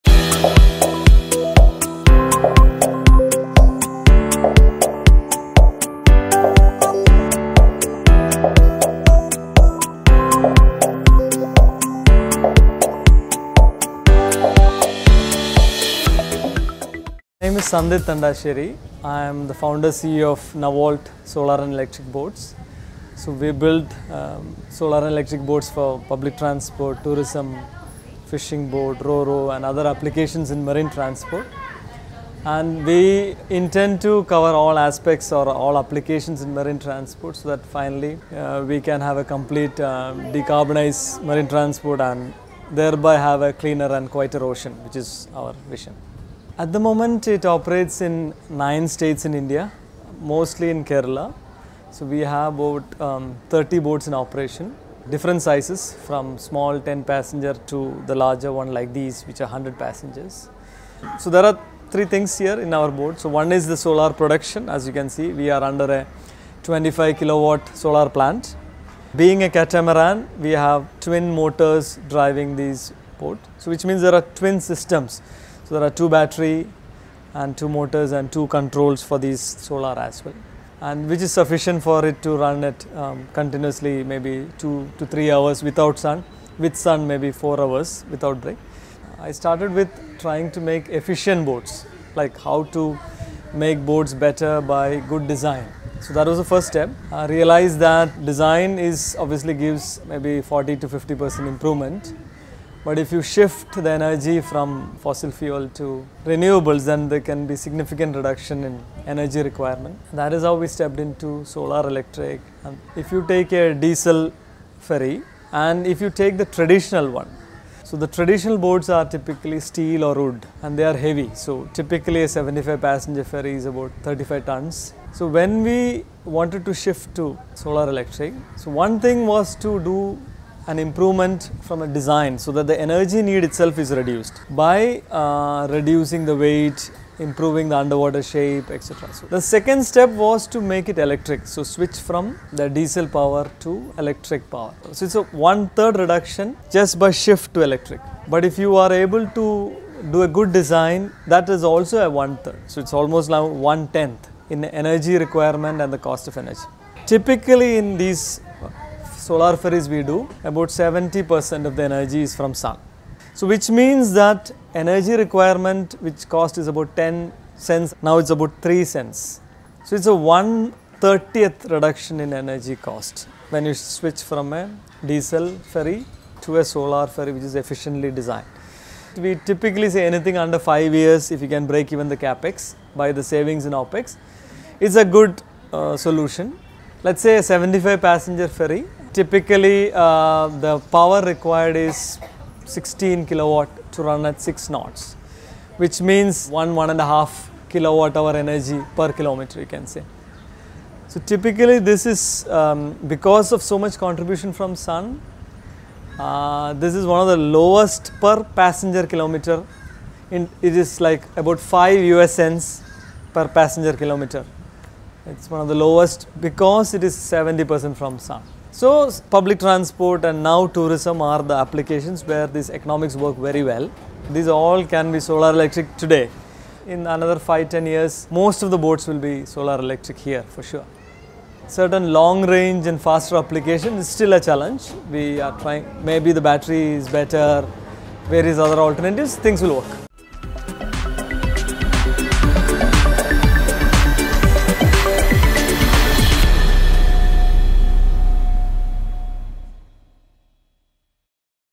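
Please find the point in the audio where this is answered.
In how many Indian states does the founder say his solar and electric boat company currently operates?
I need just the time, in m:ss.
0:48.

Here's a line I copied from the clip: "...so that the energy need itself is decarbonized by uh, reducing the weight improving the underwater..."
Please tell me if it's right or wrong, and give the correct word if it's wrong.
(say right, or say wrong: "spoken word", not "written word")
wrong: "reduced", not "decarbonized".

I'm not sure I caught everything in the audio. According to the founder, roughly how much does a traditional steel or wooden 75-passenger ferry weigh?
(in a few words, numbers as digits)
35 tons.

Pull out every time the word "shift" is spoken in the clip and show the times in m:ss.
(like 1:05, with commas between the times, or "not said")
1:43, 2:06, 2:27.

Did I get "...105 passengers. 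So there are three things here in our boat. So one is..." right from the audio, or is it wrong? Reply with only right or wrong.
wrong.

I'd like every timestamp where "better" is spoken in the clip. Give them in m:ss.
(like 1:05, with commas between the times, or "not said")
1:34, 3:57.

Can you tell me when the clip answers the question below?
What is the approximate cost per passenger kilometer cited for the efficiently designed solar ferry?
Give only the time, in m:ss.
3:31.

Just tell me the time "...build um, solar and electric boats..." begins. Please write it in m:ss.
0:23.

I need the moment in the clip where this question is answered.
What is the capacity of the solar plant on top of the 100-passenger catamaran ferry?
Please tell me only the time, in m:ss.
1:06.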